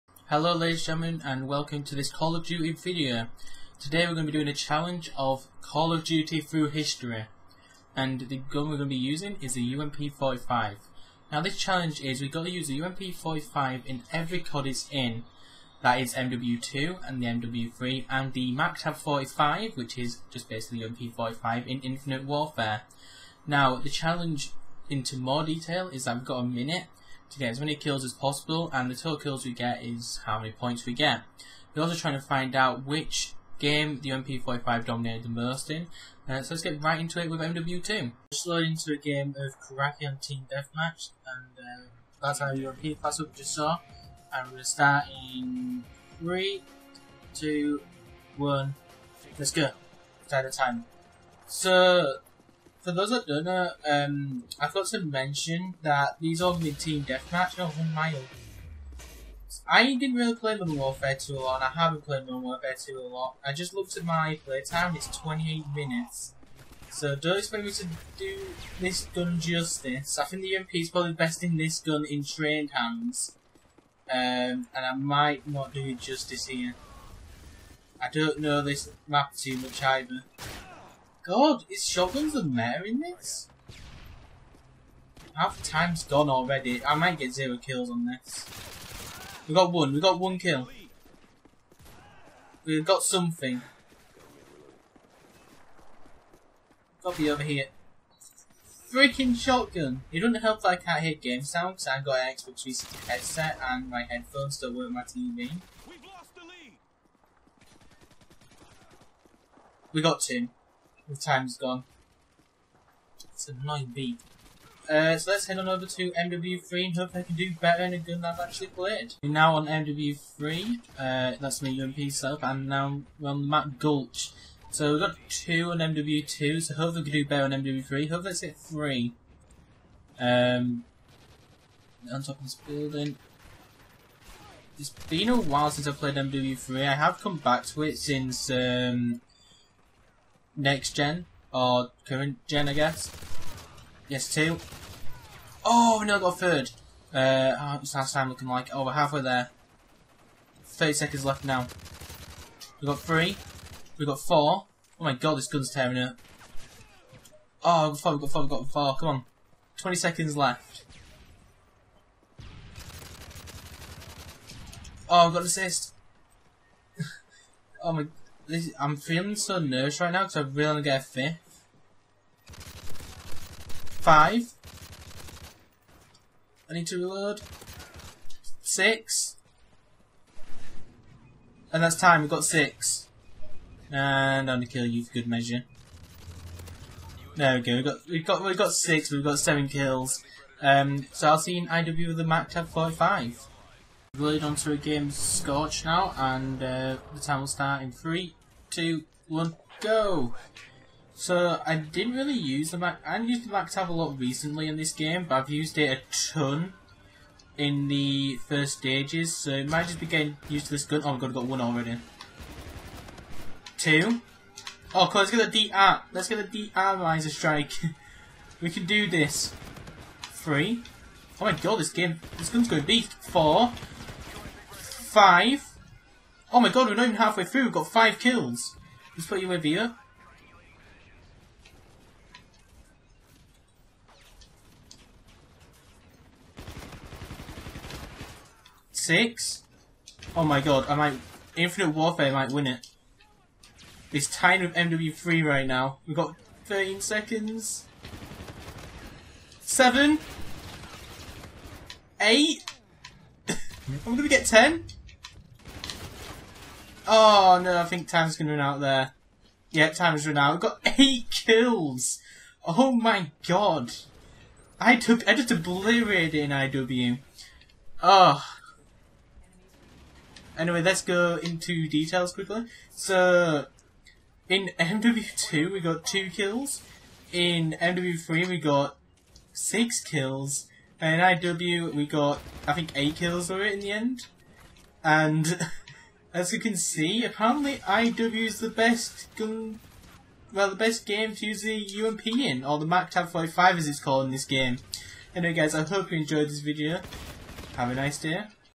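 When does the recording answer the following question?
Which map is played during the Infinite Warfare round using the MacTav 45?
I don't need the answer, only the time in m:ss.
3:15.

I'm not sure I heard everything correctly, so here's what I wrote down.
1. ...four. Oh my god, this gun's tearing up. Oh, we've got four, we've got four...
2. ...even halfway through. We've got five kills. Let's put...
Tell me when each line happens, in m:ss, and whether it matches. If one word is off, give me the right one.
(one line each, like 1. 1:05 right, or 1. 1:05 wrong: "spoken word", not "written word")
1. 2:34 right
2. 3:47 right.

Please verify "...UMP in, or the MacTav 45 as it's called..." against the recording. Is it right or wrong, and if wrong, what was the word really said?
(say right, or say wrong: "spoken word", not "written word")
right.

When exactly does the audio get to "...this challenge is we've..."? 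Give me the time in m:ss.
0:11.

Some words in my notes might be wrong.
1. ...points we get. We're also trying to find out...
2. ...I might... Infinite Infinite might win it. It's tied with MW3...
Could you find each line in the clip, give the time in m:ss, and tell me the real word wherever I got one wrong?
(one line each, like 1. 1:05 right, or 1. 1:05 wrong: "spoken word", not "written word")
1. 0:30 right
2. 4:00 wrong: "Warfare", not "Infinite".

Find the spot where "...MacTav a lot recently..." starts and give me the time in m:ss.
3:23.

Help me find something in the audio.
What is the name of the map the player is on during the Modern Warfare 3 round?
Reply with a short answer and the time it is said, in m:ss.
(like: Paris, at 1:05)
Gulch, at 2:03.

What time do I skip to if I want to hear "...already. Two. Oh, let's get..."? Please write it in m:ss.
3:31.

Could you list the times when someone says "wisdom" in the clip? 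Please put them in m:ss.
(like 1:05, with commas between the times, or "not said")
not said.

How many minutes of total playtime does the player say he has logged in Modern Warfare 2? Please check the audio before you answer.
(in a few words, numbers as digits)
28 minutes.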